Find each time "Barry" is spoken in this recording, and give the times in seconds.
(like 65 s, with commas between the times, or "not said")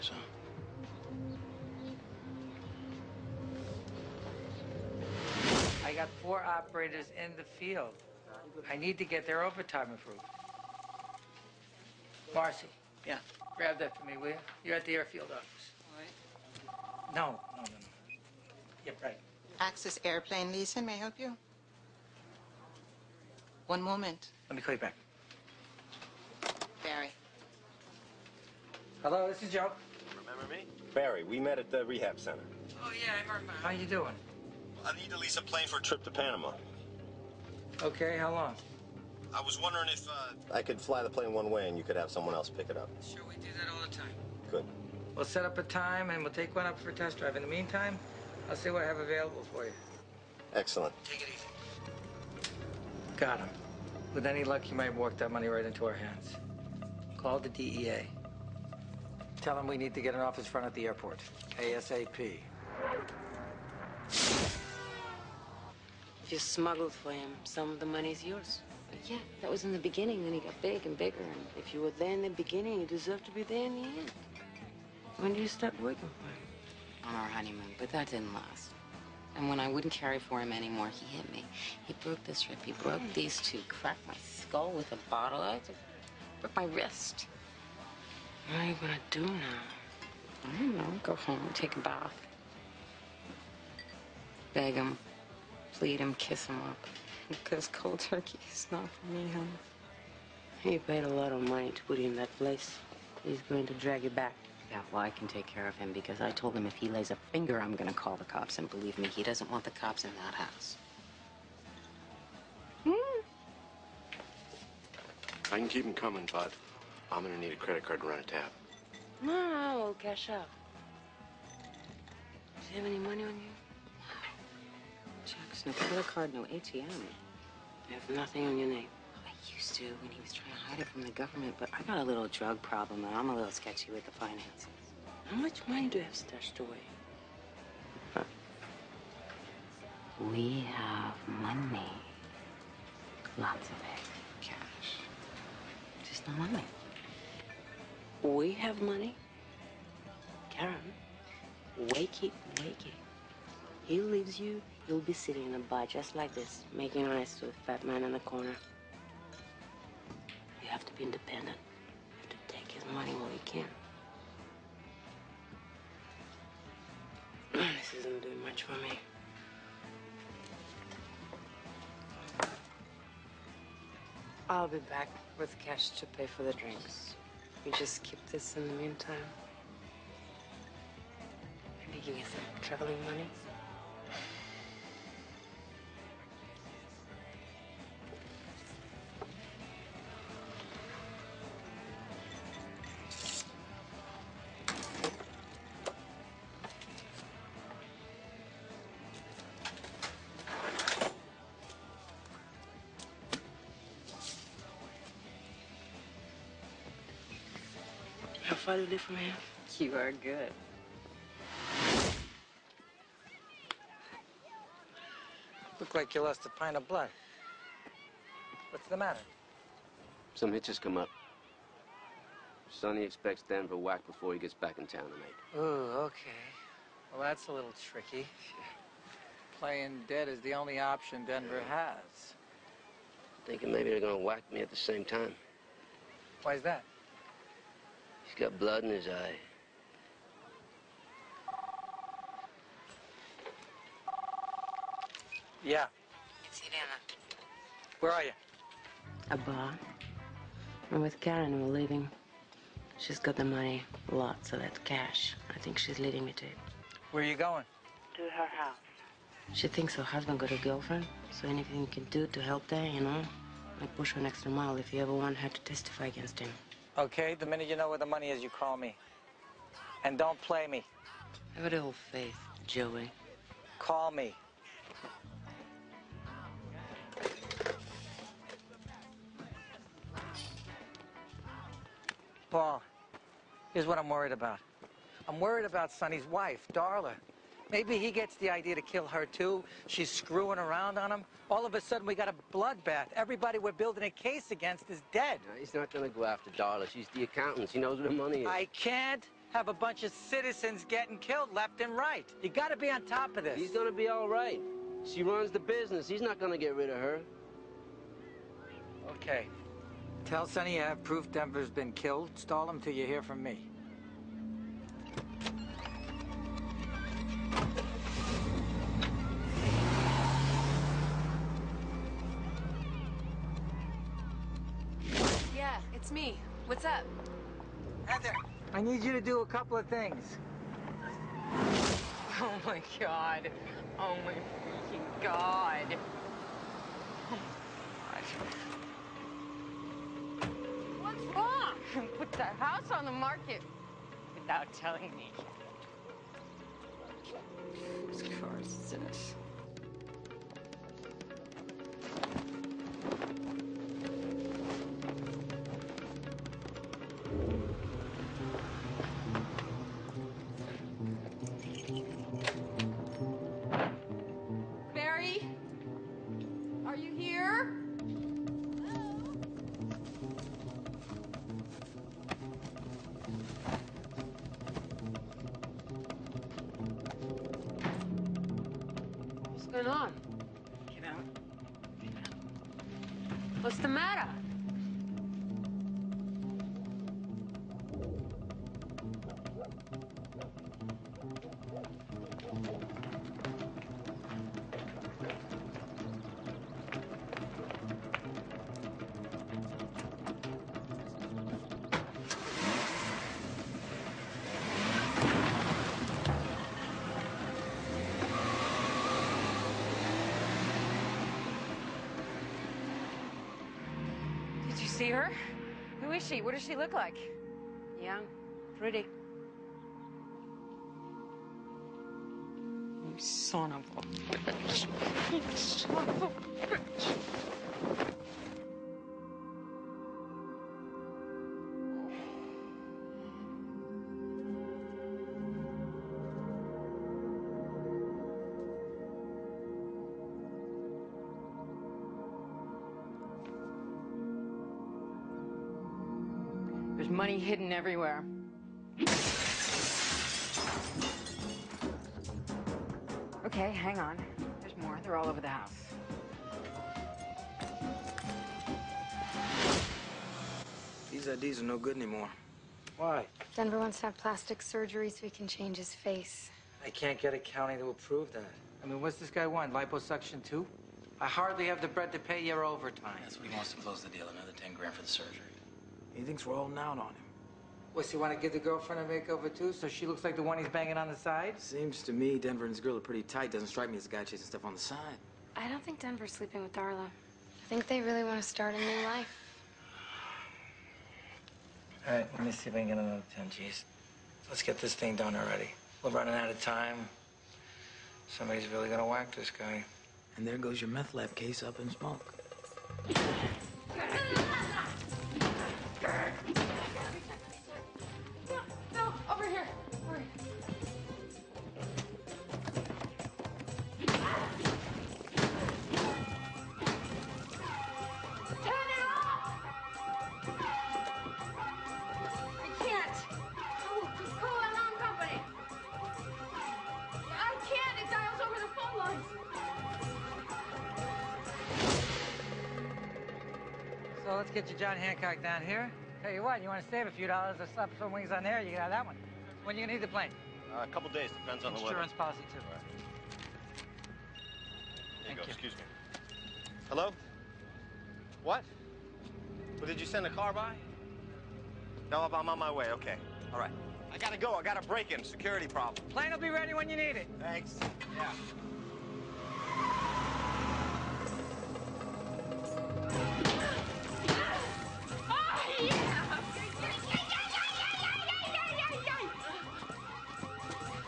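26 s, 30 s.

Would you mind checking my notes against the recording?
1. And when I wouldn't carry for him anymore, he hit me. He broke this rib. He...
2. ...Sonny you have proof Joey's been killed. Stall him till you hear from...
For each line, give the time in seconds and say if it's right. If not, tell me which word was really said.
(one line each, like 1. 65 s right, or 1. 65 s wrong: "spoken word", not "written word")
1. 79 s right
2. 310 s wrong: "Denver", not "Joey".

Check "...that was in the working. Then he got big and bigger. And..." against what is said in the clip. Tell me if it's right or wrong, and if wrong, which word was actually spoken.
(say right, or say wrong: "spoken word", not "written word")
wrong: "beginning", not "working".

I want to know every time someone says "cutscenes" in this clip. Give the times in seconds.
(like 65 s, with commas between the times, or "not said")
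not said.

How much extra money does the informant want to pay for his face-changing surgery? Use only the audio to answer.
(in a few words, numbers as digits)
10 grand.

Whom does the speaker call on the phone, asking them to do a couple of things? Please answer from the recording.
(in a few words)
Heather.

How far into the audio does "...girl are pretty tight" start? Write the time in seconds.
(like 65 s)
482 s.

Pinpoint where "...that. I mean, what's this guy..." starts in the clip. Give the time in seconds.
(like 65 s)
468 s.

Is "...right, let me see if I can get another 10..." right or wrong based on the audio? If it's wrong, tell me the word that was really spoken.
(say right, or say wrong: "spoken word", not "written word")
right.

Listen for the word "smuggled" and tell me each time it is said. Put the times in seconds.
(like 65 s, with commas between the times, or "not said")
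66 s.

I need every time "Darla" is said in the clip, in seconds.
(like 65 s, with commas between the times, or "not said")
286 s, 296 s, 486 s.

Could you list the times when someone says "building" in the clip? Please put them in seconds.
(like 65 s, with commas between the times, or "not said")
293 s.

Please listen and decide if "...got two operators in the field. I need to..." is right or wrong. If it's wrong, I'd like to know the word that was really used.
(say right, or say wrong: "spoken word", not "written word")
wrong: "four", not "two".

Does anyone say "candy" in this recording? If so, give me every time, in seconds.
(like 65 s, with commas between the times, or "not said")
not said.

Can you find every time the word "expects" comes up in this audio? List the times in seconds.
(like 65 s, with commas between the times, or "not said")
223 s.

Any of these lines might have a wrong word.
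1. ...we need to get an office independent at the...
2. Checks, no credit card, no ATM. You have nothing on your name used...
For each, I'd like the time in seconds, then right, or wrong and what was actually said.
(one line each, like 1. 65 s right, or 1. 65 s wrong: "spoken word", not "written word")
1. 59 s wrong: "front", not "independent"
2. 125 s right.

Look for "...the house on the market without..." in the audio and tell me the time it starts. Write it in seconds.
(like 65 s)
342 s.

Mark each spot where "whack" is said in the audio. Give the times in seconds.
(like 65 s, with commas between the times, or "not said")
223 s, 234 s, 499 s.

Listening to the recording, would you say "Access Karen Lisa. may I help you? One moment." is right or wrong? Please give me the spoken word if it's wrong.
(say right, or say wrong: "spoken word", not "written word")
wrong: "Airplane", not "Karen".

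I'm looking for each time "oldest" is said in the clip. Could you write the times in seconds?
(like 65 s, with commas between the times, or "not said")
not said.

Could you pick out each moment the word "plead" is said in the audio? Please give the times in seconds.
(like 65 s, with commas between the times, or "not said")
95 s.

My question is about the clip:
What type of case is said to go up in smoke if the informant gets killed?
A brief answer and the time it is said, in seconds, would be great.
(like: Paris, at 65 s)
meth lab case, at 500 s.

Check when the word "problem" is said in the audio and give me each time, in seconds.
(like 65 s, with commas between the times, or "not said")
132 s, 555 s.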